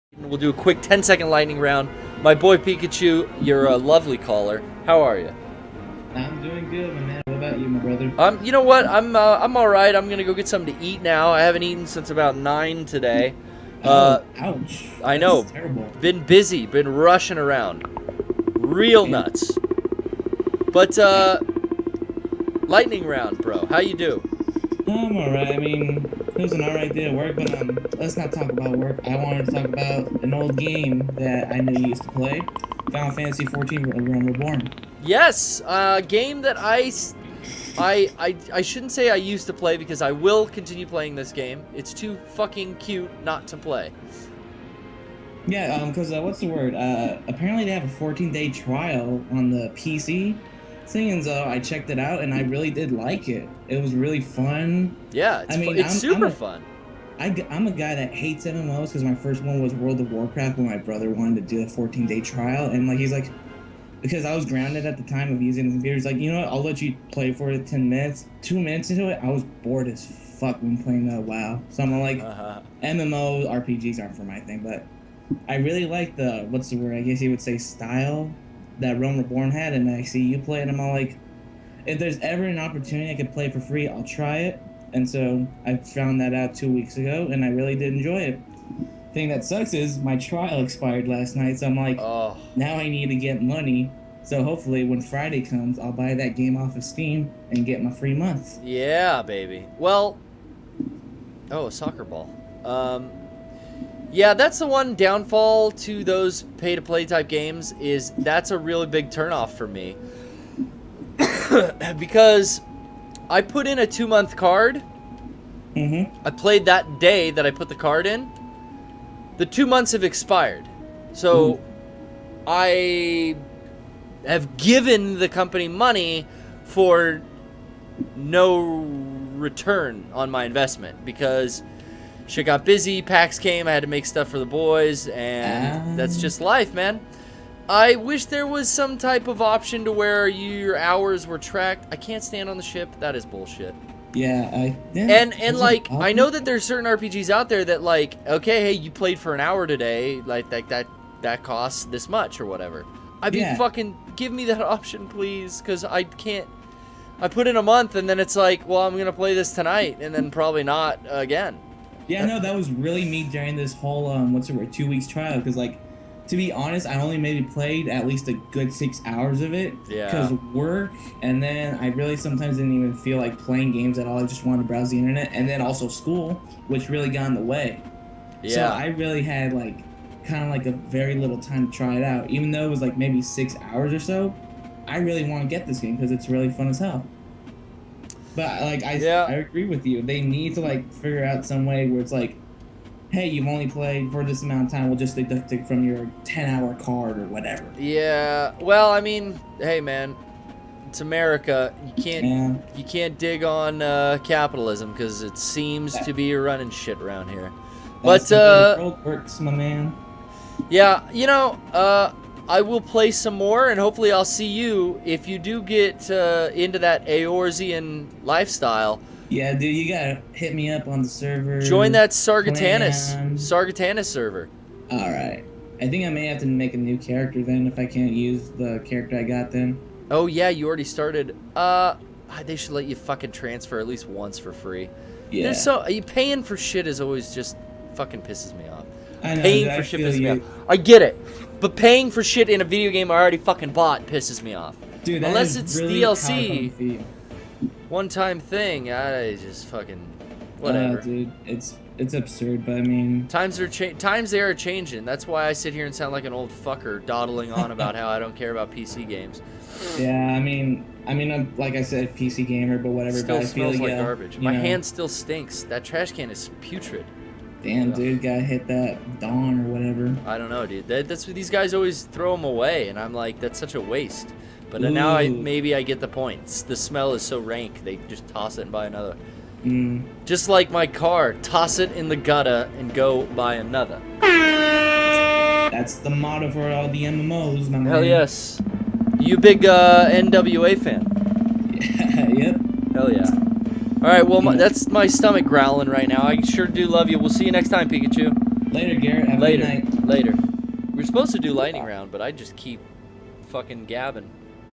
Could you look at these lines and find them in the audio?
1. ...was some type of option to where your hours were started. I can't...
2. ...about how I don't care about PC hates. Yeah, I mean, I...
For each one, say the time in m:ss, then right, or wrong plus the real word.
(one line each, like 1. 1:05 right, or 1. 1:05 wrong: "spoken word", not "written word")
1. 2:18 wrong: "tracked", not "started"
2. 4:17 wrong: "games", not "hates".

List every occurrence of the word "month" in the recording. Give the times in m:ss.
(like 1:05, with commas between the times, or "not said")
1:38, 1:53, 1:59, 2:37.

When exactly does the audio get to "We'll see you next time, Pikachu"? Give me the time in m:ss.
4:57.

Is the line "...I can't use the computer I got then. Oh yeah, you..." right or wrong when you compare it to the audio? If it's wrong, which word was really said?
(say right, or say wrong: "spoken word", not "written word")
wrong: "character", not "computer".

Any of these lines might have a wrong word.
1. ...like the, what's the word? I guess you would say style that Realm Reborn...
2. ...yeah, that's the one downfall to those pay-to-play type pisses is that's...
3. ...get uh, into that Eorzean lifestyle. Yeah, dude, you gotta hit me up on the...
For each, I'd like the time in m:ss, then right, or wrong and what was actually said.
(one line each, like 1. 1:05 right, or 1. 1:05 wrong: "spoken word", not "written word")
1. 1:15 right
2. 1:44 wrong: "games", not "pisses"
3. 3:35 right.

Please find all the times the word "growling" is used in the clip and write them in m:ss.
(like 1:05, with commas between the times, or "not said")
4:55.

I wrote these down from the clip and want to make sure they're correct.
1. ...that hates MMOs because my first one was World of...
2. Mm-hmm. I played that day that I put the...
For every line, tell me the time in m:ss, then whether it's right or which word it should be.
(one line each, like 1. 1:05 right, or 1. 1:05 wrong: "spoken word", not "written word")
1. 0:57 right
2. 1:55 right.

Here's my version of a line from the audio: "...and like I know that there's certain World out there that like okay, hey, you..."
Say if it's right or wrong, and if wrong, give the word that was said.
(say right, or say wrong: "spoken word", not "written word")
wrong: "RPGs", not "World".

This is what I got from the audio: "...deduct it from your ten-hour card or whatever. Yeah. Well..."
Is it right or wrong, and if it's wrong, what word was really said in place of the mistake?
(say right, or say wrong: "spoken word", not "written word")
right.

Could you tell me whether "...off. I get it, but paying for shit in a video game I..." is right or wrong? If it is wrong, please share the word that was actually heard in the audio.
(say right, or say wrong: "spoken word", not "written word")
right.